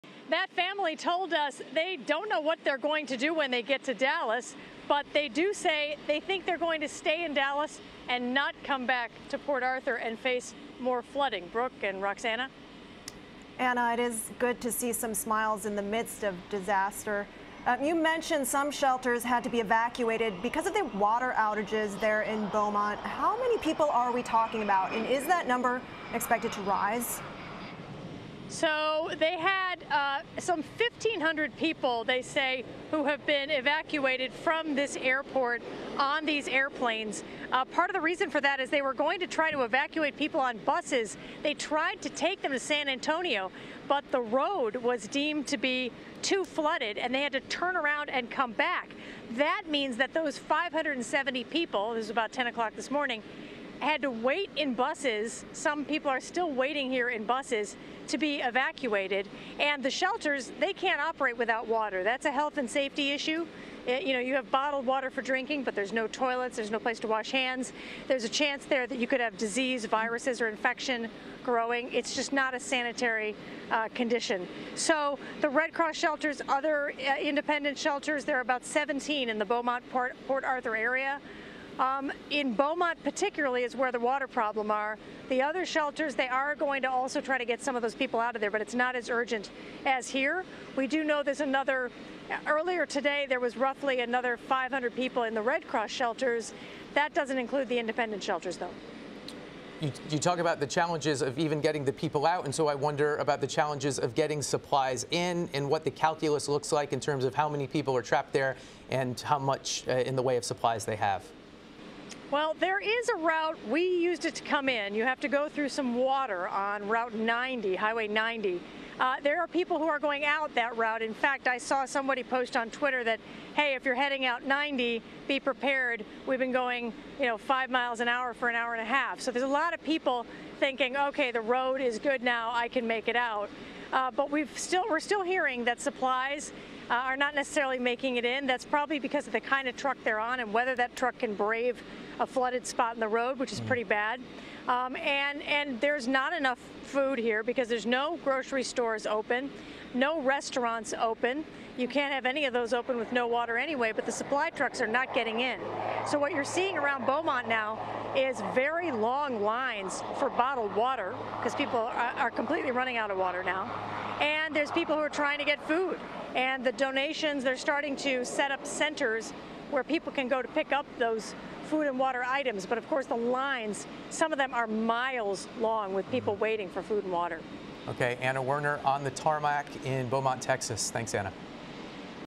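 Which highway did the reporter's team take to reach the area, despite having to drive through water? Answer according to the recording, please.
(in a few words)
Highway 90.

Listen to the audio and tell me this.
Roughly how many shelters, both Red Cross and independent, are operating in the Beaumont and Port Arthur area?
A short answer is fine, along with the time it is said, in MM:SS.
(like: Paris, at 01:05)
17, at 01:18.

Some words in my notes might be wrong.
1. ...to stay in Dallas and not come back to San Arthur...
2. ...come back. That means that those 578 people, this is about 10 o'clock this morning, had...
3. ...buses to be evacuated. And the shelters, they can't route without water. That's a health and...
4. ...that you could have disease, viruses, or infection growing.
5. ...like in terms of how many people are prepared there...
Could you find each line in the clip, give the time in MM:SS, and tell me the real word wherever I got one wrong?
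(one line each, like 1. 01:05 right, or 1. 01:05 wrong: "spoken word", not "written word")
1. 00:06 wrong: "Port", not "San"
2. 00:48 wrong: "570", not "578"
3. 00:57 wrong: "operate", not "route"
4. 01:08 right
5. 01:46 wrong: "trapped", not "prepared".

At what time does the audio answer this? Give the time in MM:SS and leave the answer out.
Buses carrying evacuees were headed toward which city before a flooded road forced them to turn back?
00:42.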